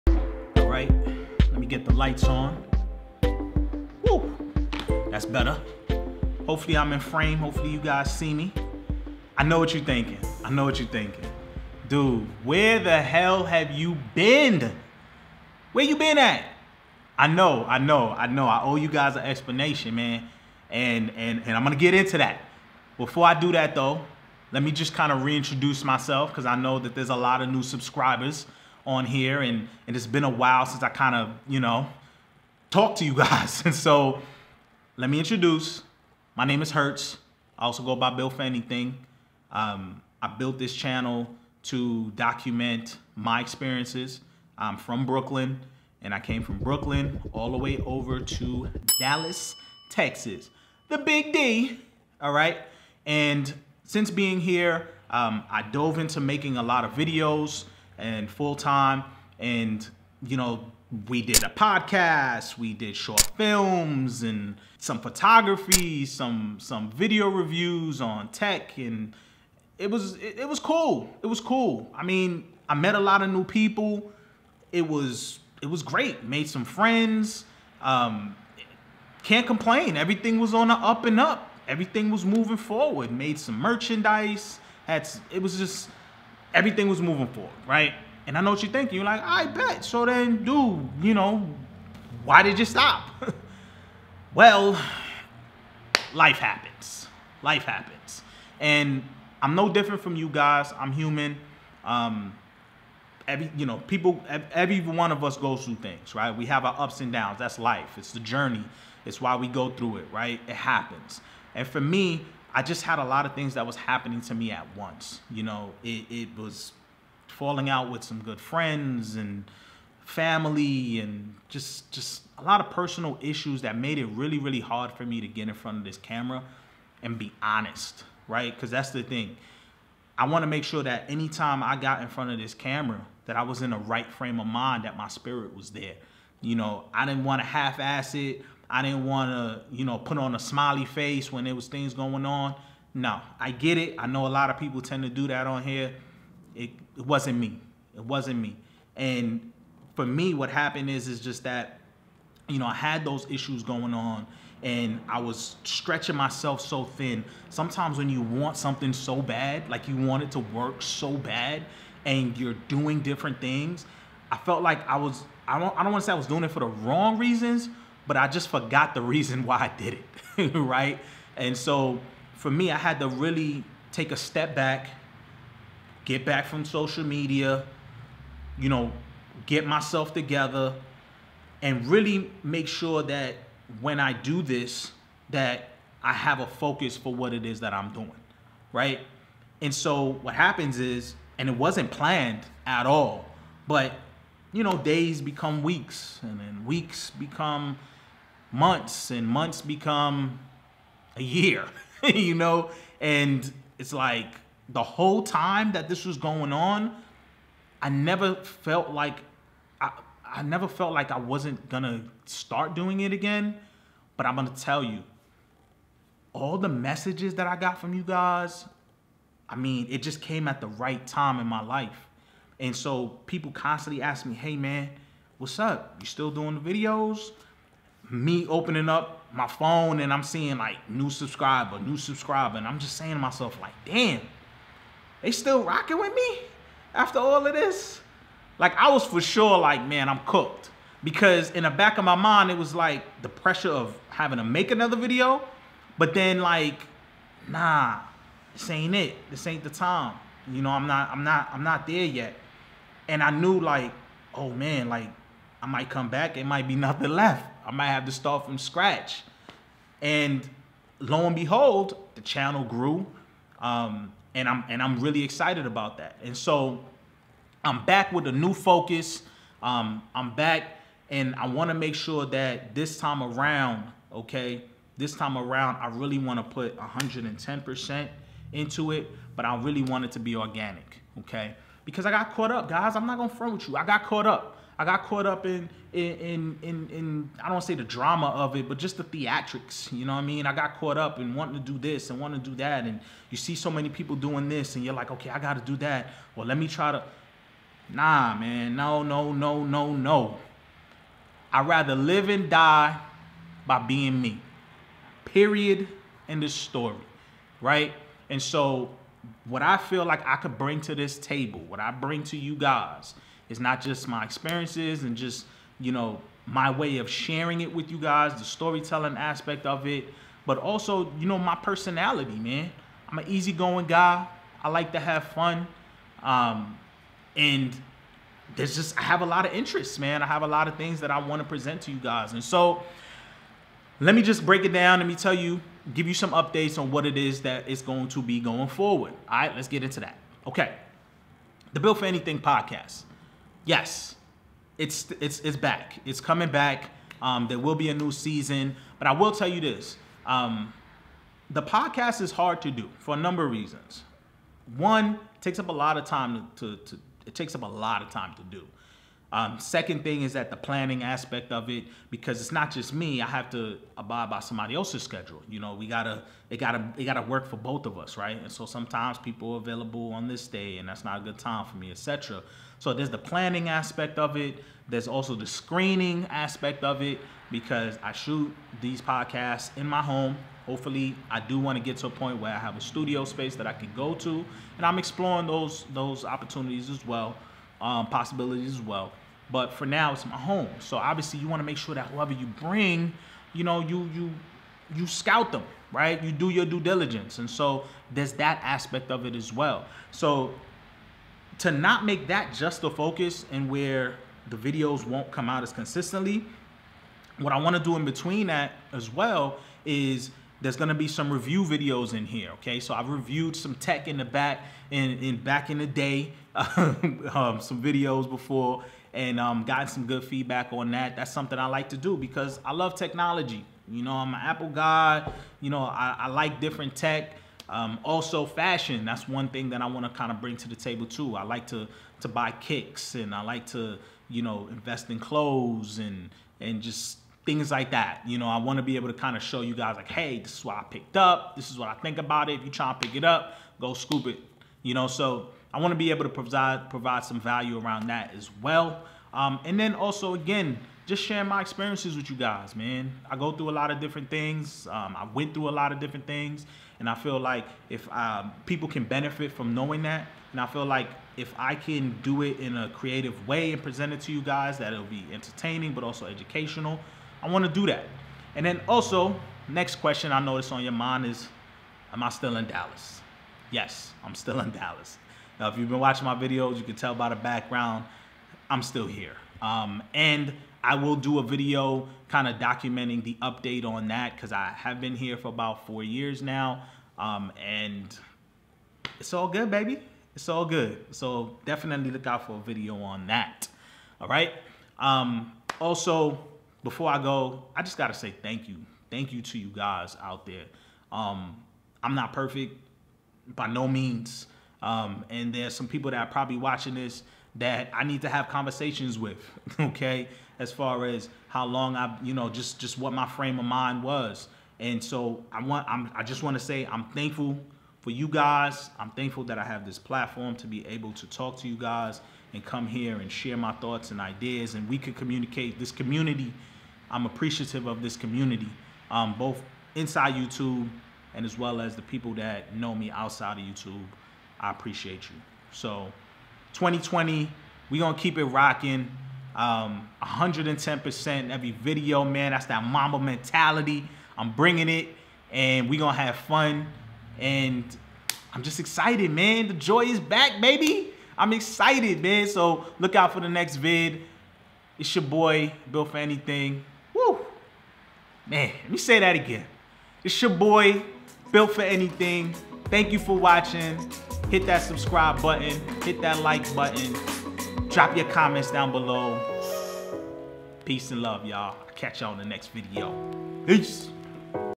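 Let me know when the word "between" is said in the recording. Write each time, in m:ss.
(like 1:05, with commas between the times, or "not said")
6:48.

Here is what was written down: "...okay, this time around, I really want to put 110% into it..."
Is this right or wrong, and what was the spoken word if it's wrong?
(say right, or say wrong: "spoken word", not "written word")
right.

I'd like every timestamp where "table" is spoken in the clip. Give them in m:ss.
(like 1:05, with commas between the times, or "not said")
5:11, 7:10.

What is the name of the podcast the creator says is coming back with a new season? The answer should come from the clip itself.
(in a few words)
Built4Anything podcast.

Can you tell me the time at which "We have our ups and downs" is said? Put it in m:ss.
1:46.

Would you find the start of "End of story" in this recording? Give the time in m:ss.
5:06.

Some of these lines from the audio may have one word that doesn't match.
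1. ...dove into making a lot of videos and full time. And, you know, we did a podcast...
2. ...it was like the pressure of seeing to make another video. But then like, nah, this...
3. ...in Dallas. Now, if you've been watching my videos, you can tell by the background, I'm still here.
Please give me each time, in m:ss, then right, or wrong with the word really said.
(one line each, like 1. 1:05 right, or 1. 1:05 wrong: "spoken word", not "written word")
1. 0:55 right
2. 4:02 wrong: "having", not "seeing"
3. 7:54 right.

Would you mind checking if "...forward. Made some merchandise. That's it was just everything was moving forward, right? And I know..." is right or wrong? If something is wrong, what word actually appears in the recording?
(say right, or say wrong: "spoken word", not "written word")
right.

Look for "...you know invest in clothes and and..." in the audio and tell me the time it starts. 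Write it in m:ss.
7:14.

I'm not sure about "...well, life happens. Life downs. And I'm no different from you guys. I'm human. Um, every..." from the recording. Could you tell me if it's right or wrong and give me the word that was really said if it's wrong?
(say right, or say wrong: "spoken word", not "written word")
wrong: "happens", not "downs".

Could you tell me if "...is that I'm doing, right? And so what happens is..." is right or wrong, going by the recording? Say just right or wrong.
right.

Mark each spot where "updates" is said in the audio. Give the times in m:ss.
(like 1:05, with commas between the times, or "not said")
5:36, 8:03.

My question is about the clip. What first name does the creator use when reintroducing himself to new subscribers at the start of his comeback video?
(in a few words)
Hertz.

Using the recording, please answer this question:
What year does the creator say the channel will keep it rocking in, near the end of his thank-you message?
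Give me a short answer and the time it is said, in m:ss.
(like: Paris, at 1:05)
2020, at 8:56.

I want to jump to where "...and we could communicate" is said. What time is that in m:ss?
8:44.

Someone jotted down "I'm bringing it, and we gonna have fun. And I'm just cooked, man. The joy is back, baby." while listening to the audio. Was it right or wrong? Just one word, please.
wrong.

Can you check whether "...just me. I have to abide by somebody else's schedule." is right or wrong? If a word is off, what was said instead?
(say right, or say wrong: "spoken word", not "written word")
right.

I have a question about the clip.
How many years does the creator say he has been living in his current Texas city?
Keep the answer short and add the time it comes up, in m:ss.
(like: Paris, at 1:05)
4, at 8:05.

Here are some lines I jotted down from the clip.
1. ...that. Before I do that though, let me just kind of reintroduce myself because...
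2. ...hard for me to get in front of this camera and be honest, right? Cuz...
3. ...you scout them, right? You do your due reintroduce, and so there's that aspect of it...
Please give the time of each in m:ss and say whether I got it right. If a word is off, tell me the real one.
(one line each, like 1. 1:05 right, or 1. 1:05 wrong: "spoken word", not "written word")
1. 0:22 right
2. 2:04 right
3. 6:34 wrong: "diligence", not "reintroduce".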